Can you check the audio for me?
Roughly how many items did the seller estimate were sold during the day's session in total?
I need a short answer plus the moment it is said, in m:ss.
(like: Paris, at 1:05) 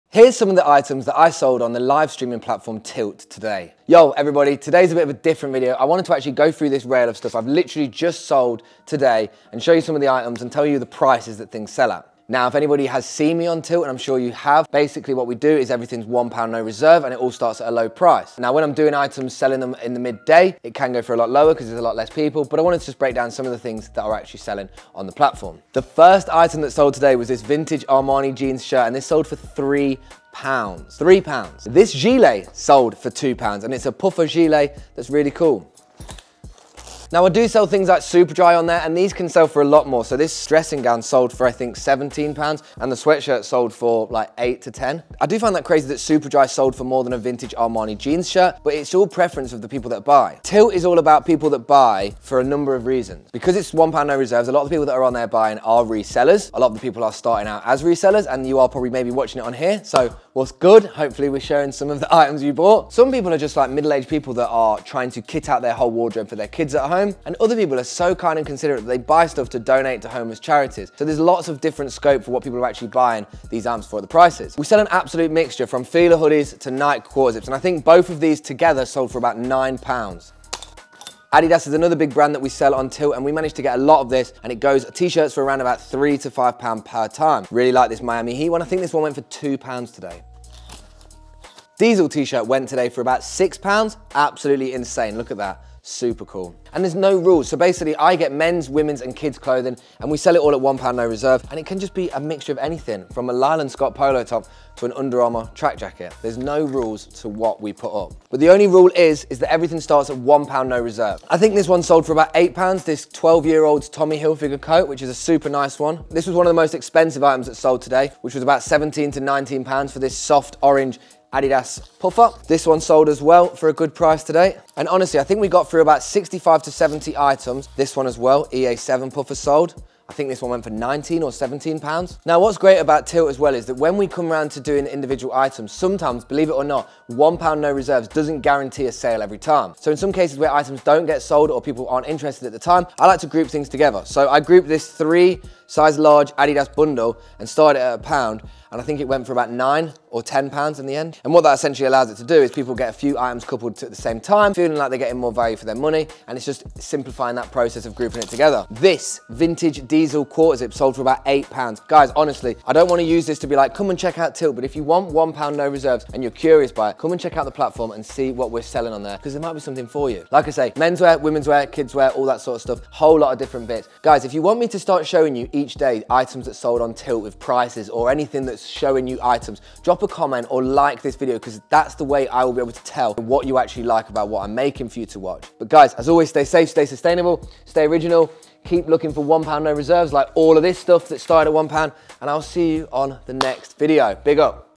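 65 to 70, at 2:06.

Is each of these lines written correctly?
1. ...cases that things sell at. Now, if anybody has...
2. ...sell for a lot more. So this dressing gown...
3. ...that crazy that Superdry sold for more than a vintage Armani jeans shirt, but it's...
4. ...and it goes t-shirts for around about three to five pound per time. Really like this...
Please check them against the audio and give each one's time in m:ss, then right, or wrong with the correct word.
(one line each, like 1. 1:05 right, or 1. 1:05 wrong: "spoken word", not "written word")
1. 0:10 wrong: "prices", not "cases"
2. 0:39 right
3. 0:45 right
4. 1:24 right.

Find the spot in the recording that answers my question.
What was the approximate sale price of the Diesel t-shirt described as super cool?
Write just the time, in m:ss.
1:32.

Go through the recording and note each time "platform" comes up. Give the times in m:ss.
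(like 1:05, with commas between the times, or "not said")
0:02, 0:25, 2:47.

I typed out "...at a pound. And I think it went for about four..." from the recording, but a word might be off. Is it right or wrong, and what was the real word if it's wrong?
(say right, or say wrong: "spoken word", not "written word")
wrong: "nine", not "four".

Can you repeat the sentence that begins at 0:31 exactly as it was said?
This gilet sold for two pounds and it's a puffer gilet that's really cool.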